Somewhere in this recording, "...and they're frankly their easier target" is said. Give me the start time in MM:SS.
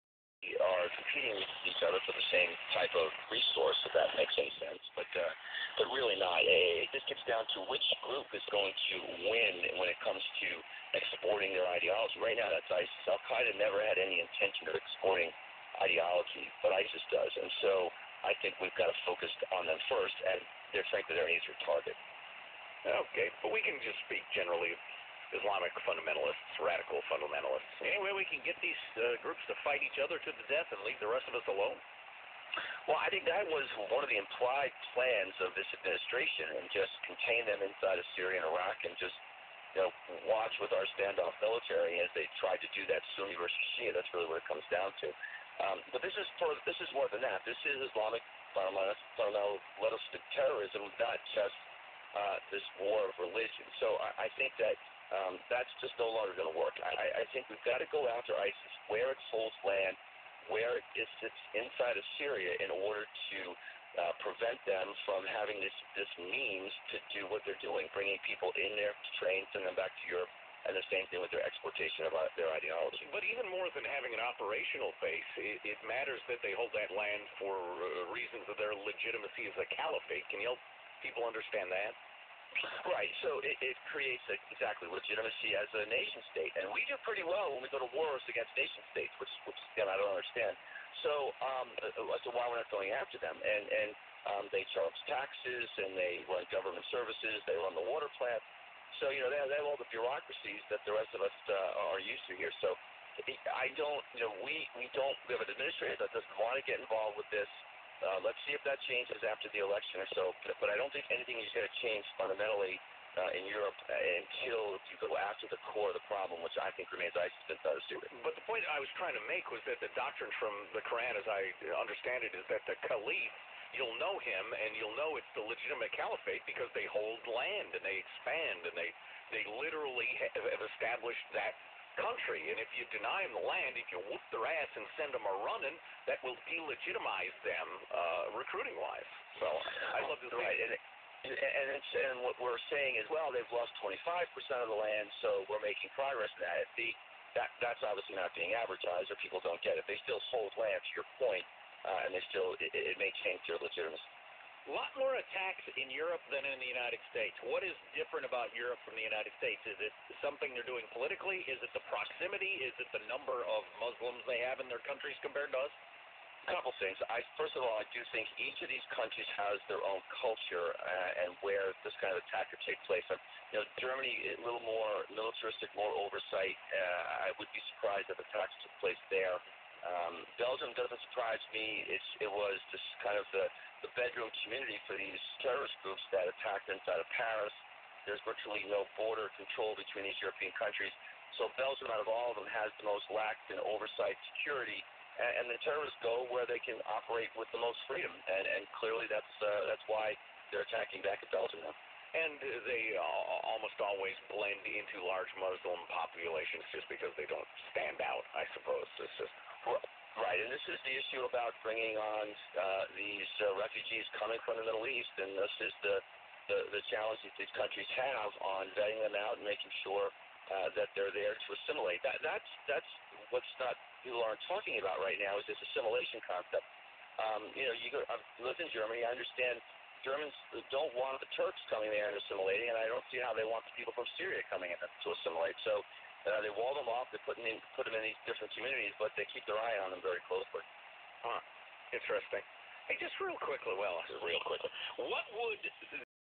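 00:20.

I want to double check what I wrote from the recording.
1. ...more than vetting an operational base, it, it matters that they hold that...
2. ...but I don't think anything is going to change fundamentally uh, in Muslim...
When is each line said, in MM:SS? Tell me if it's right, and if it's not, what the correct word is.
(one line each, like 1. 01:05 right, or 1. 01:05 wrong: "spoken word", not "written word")
1. 01:13 wrong: "having", not "vetting"
2. 01:50 wrong: "Europe", not "Muslim".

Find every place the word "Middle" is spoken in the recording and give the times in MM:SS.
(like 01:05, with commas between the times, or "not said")
03:34.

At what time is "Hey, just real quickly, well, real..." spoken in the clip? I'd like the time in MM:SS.
04:02.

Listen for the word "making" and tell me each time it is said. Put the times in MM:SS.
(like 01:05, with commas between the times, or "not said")
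02:25, 03:39.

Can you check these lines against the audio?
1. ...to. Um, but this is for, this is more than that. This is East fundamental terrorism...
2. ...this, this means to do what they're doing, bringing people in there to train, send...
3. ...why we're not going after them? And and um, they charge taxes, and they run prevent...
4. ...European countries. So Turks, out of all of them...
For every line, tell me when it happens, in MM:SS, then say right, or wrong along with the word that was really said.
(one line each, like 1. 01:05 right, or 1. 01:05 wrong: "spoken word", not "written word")
1. 00:44 wrong: "Islamic", not "East"
2. 01:05 right
3. 01:32 wrong: "government", not "prevent"
4. 03:10 wrong: "Belgium", not "Turks".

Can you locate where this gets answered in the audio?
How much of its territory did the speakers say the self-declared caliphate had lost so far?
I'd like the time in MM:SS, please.
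02:23.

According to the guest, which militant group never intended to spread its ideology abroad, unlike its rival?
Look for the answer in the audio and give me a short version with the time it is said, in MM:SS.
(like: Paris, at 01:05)
Al Qaeda, at 00:13.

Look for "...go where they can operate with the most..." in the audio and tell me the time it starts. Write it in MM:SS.
03:16.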